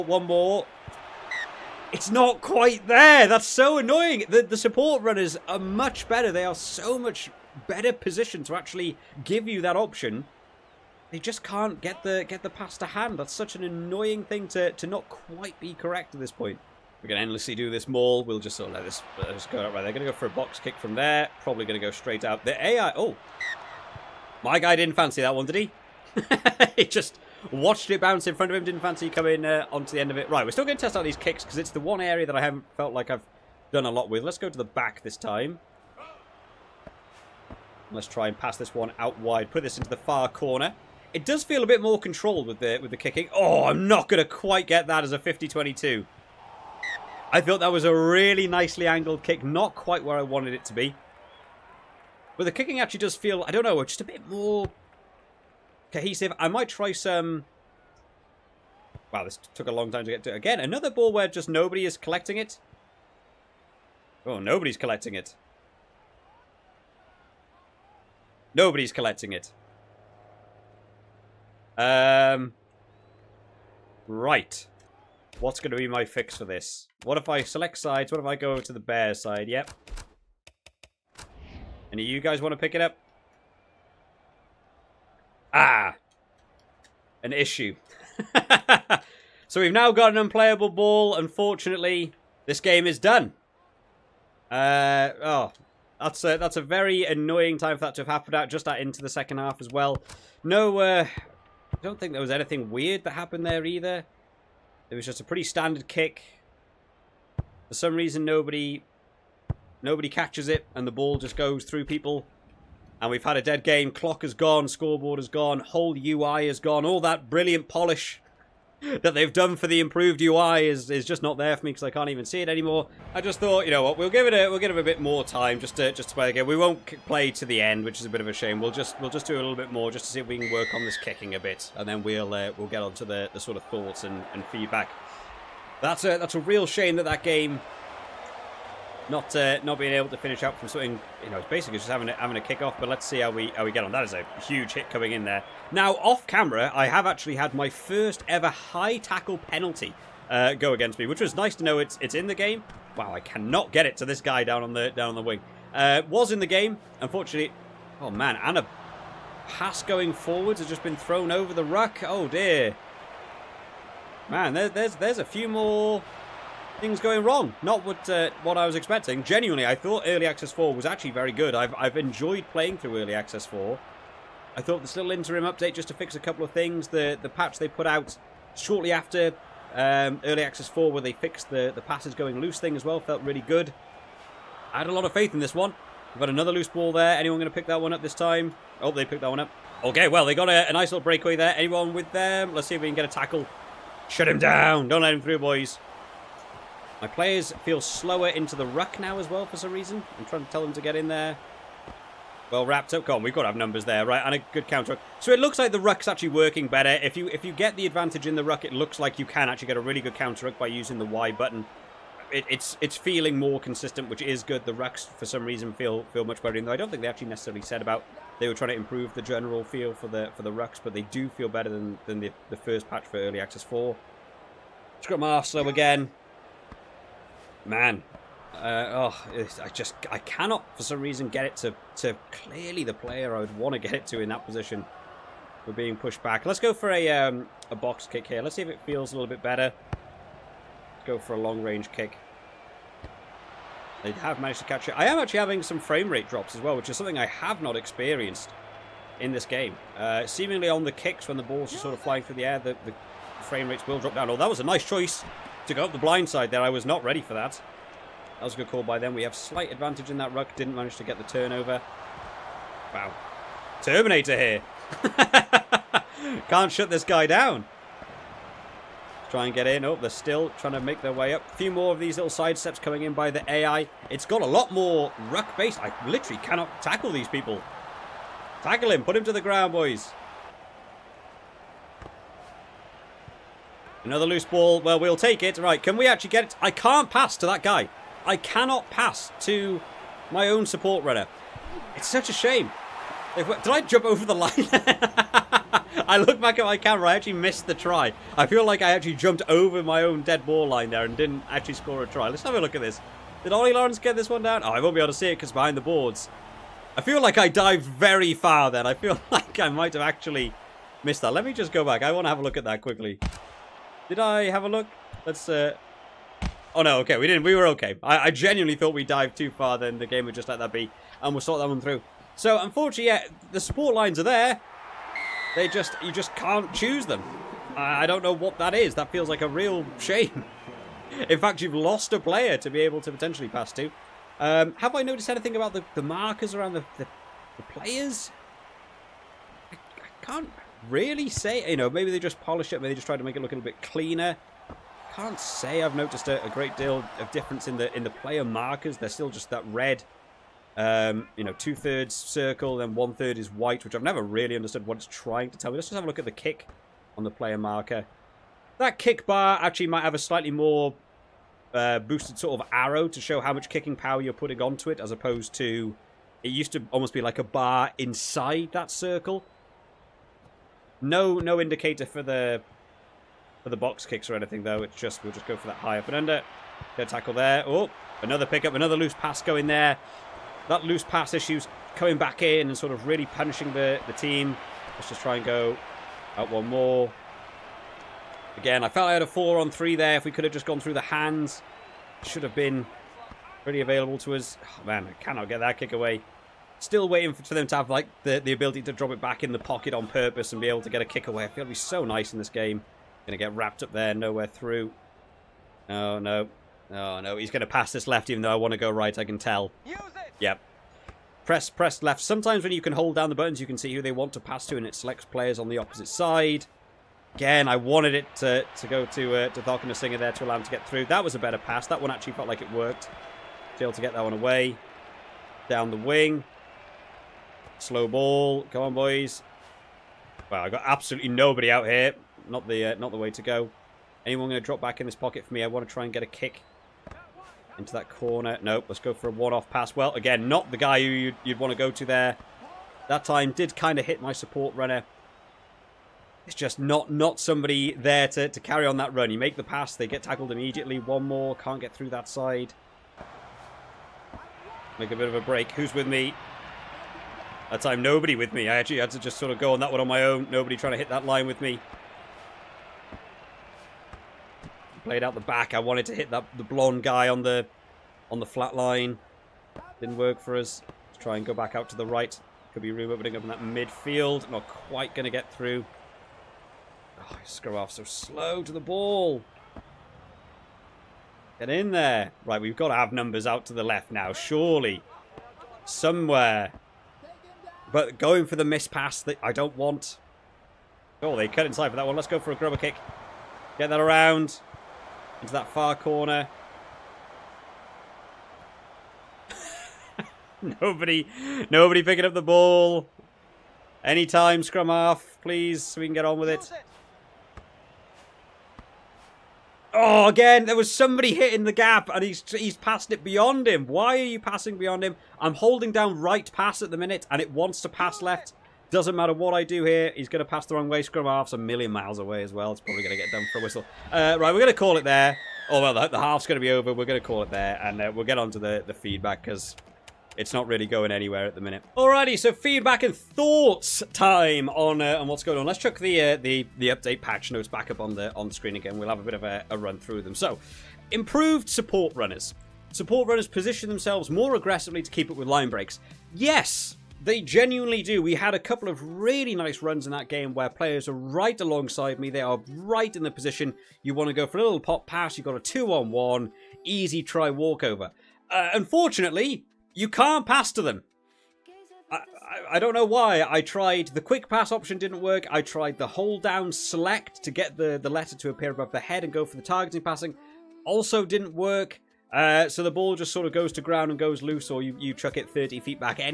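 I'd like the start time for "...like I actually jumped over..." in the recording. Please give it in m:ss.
4:58.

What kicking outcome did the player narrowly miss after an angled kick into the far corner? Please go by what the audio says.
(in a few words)
50-22.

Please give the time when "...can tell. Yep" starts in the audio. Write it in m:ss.
6:49.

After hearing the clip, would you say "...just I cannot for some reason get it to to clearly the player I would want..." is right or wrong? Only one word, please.
right.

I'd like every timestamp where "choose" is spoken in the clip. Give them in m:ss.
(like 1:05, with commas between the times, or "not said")
5:26.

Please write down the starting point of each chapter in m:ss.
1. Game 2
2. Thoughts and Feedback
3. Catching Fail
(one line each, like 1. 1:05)
1. 2:02
2. 8:51
3. 0:16.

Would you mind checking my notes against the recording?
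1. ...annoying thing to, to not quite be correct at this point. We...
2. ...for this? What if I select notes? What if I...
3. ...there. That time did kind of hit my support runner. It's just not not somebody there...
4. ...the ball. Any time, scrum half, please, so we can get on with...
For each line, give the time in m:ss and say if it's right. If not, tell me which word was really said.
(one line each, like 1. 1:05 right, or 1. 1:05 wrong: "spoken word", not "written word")
1. 0:13 right
2. 1:16 wrong: "sides", not "notes"
3. 7:22 right
4. 8:22 right.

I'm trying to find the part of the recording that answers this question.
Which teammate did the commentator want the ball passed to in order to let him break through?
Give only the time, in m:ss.
6:59.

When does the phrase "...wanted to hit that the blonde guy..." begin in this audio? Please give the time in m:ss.
7:45.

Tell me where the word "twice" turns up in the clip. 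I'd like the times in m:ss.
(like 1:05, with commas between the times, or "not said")
not said.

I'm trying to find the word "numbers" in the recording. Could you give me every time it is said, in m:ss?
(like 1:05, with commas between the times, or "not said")
3:23, 8:03.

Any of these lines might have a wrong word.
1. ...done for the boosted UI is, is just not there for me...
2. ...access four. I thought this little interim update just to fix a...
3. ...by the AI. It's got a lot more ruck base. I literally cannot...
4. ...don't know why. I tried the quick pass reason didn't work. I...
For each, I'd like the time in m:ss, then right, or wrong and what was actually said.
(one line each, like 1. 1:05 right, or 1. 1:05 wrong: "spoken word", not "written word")
1. 1:59 wrong: "improved", not "boosted"
2. 2:53 right
3. 4:33 right
4. 9:22 wrong: "option", not "reason".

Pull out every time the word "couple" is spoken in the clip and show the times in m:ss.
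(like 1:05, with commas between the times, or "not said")
2:56, 9:08.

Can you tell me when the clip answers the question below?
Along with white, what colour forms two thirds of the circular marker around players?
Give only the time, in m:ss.
5:49.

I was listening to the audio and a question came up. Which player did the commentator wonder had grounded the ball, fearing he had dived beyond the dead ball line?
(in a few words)
Ollie Lawrence.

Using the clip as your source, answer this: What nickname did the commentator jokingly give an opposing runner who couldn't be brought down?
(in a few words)
Terminator.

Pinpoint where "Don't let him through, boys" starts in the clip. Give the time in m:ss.
3:14.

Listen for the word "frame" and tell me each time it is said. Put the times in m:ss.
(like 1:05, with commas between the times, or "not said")
4:05, 4:13.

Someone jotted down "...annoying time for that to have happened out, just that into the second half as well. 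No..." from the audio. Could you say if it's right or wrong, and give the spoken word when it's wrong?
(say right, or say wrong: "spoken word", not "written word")
right.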